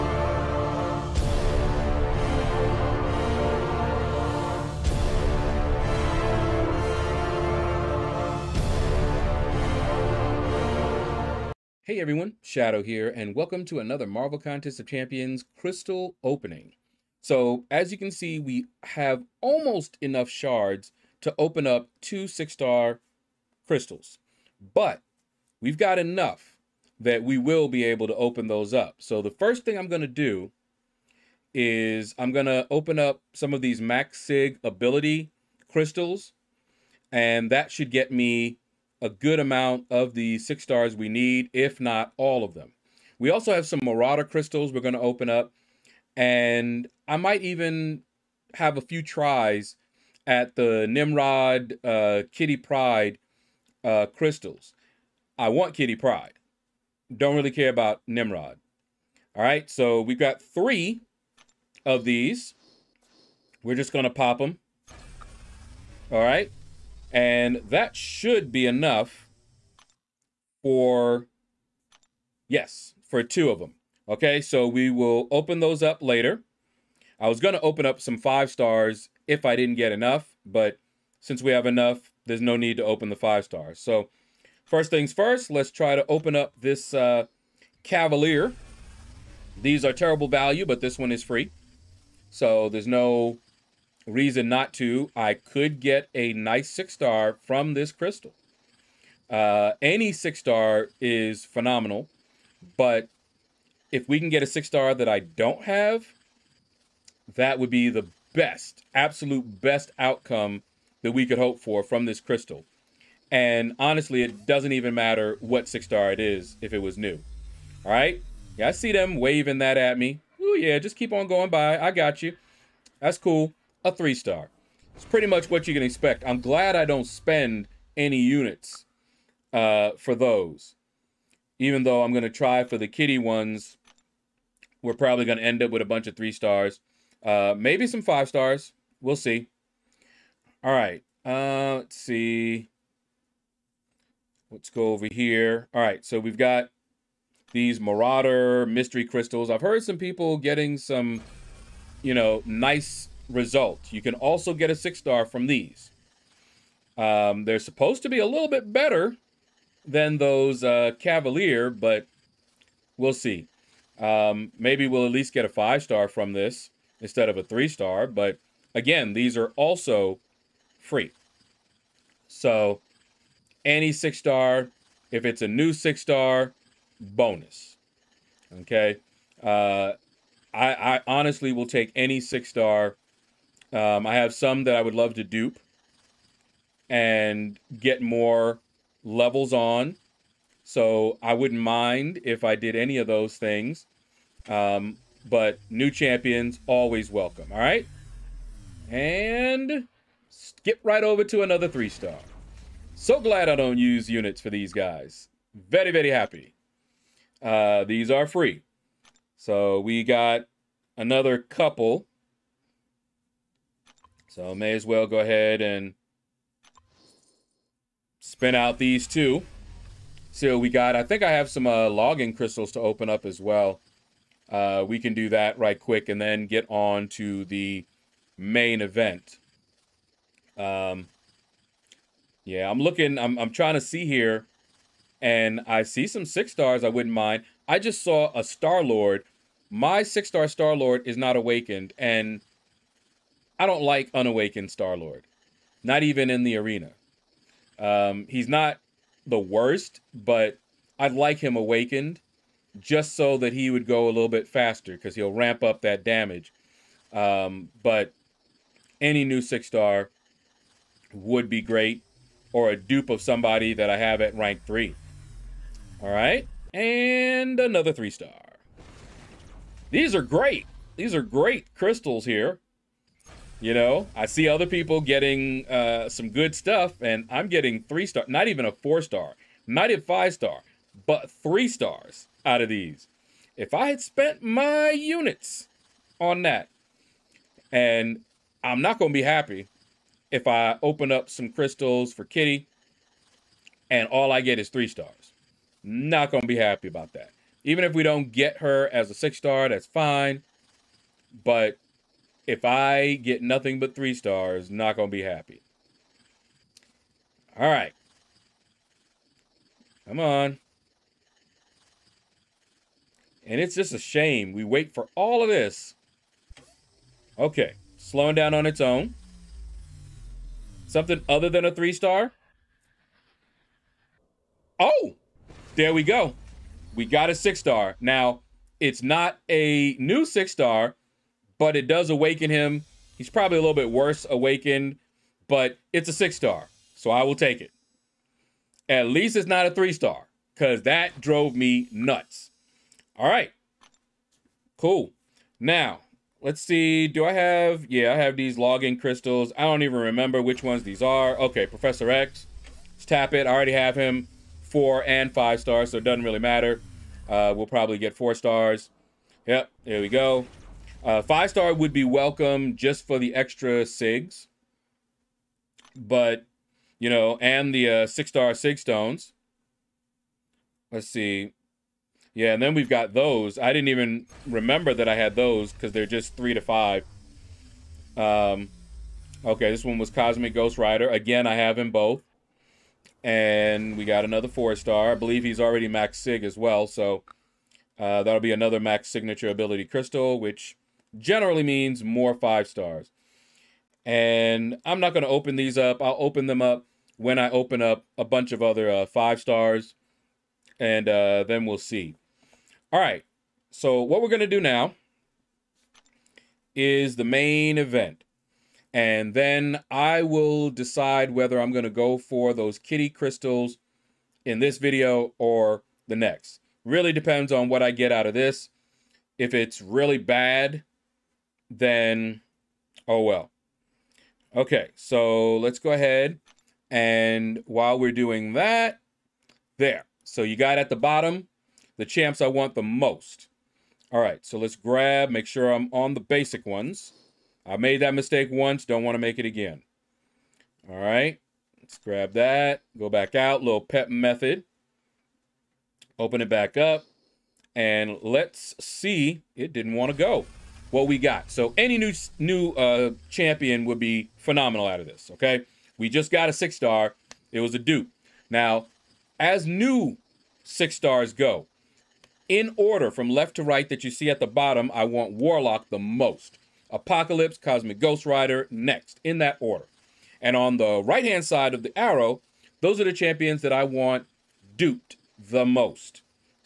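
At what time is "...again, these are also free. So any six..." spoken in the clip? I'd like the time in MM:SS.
02:48.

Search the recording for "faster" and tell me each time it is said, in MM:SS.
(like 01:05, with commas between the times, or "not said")
04:14.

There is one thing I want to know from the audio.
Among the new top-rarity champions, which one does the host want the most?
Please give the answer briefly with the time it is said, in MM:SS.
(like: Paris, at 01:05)
Warlock, at 07:45.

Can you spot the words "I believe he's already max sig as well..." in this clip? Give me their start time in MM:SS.
06:25.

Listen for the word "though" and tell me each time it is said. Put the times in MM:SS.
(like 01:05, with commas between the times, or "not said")
02:11.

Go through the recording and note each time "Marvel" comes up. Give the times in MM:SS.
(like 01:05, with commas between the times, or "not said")
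00:14.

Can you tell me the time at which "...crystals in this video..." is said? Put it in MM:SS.
06:53.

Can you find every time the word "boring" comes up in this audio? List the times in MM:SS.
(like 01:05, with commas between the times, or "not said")
not said.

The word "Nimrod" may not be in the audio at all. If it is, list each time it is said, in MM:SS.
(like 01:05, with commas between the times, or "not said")
00:50, 00:58.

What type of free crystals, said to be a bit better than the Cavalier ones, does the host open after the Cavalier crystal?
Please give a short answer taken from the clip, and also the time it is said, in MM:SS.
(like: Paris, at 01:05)
Marauder mystery crystals, at 02:27.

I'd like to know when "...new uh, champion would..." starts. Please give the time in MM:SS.
07:32.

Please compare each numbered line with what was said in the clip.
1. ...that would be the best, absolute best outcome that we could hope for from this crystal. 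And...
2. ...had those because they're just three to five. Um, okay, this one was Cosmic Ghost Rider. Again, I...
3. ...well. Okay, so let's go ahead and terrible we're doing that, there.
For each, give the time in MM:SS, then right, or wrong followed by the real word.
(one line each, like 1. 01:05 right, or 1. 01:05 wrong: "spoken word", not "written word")
1. 01:47 right
2. 06:15 right
3. 07:03 wrong: "while", not "terrible".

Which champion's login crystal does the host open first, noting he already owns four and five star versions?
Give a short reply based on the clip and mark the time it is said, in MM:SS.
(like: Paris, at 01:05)
Professor X, at 05:51.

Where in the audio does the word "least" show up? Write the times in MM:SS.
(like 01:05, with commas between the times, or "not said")
02:45, 05:39.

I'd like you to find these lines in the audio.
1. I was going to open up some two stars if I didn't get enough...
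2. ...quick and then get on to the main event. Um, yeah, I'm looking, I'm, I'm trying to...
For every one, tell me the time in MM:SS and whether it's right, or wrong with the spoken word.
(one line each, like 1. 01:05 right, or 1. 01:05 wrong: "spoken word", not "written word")
1. 01:17 wrong: "five", not "two"
2. 03:45 right.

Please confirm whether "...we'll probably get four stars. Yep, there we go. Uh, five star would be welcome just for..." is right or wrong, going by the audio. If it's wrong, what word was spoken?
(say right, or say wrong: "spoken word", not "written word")
right.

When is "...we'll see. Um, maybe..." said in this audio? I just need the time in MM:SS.
02:42.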